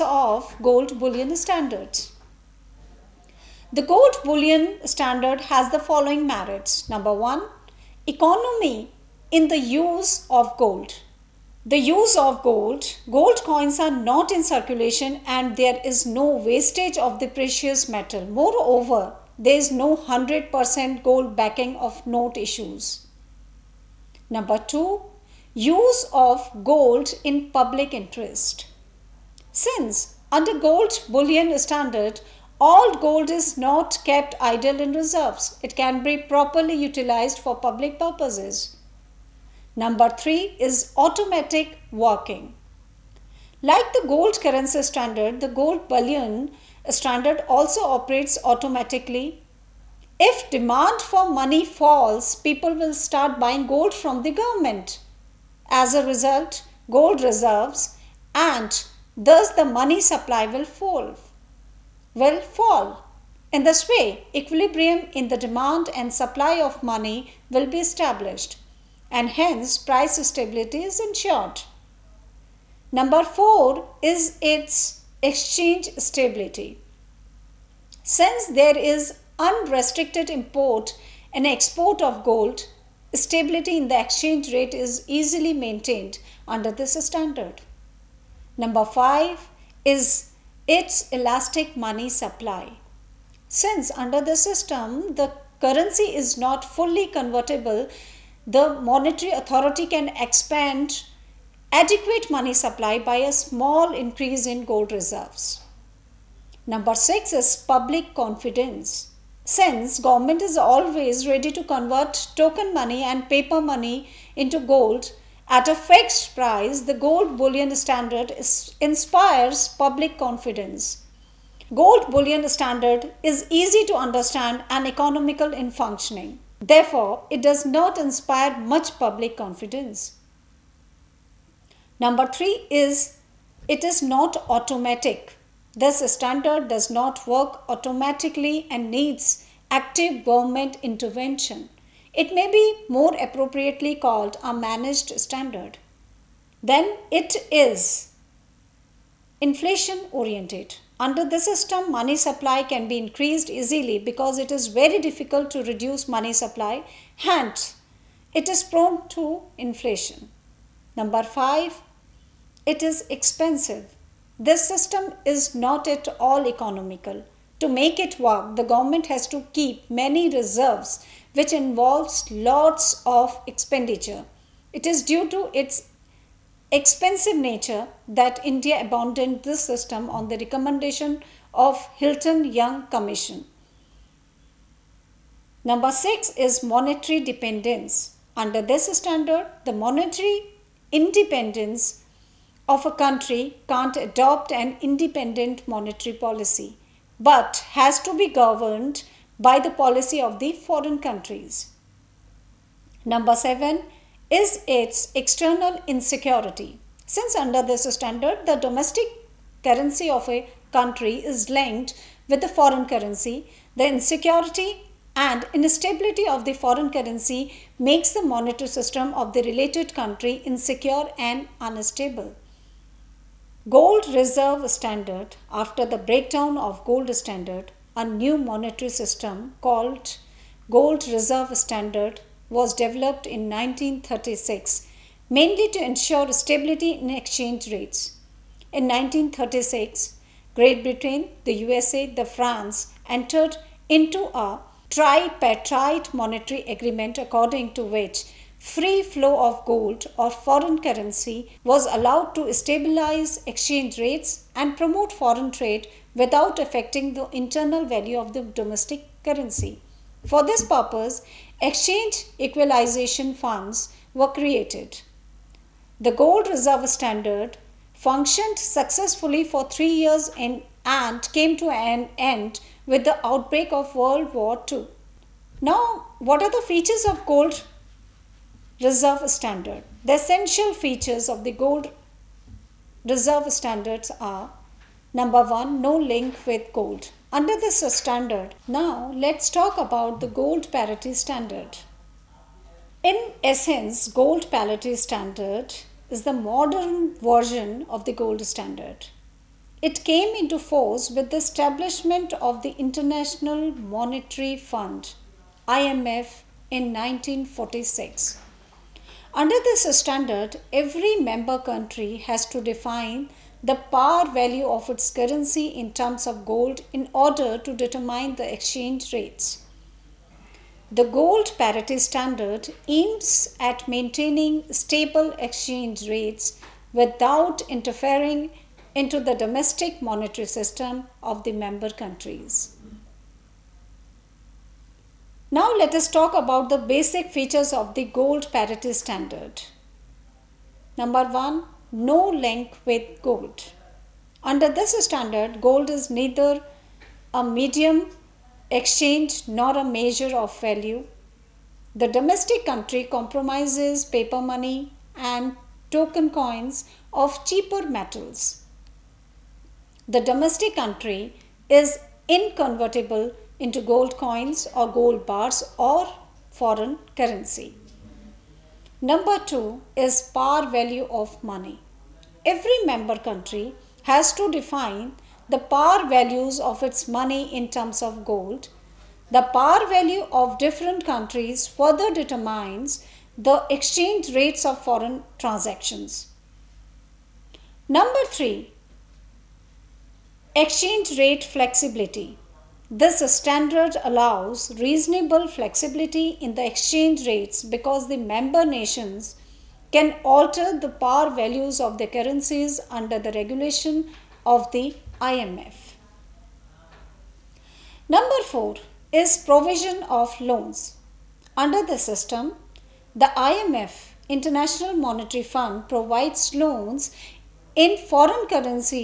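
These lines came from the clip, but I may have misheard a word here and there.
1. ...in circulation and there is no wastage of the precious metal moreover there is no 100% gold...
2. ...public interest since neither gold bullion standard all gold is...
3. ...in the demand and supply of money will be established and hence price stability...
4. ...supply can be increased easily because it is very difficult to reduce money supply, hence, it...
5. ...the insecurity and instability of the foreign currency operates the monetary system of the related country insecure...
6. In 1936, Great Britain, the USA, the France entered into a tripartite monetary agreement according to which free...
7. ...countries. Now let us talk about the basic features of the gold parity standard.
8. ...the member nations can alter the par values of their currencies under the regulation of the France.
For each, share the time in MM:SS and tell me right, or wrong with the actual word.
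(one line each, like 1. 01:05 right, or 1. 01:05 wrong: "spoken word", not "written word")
1. 00:14 right
2. 00:27 wrong: "under", not "neither"
3. 01:05 right
4. 02:32 right
5. 03:33 wrong: "makes", not "operates"
6. 03:58 right
7. 05:31 right
8. 06:38 wrong: "IMF", not "France".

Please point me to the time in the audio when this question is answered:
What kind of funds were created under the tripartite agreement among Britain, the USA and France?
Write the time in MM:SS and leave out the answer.
04:21.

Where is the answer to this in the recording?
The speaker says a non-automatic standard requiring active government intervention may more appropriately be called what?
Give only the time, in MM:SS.
02:24.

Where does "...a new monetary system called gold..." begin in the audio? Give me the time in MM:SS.
03:47.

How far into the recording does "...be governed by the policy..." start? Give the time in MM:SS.
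03:18.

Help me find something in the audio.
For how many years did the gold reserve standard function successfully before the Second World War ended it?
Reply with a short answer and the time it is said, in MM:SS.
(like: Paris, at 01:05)
3, at 04:29.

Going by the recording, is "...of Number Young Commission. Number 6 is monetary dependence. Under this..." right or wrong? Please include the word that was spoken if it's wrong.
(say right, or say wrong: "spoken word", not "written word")
wrong: "Hilton", not "Number".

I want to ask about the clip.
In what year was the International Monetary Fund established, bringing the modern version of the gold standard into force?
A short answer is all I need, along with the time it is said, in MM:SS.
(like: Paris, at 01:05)
1946, at 05:06.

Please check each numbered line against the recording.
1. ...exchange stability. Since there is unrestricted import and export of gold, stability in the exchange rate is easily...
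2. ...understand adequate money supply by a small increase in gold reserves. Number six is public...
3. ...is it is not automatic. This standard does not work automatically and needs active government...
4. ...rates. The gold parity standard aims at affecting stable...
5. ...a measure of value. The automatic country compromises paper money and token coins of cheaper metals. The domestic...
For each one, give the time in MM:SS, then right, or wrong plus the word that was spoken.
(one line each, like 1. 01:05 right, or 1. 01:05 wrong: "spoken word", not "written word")
1. 01:15 right
2. 01:40 wrong: "expand", not "understand"
3. 02:12 right
4. 05:19 wrong: "maintaining", not "affecting"
5. 05:49 wrong: "domestic", not "automatic".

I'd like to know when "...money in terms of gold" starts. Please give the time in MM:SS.
06:17.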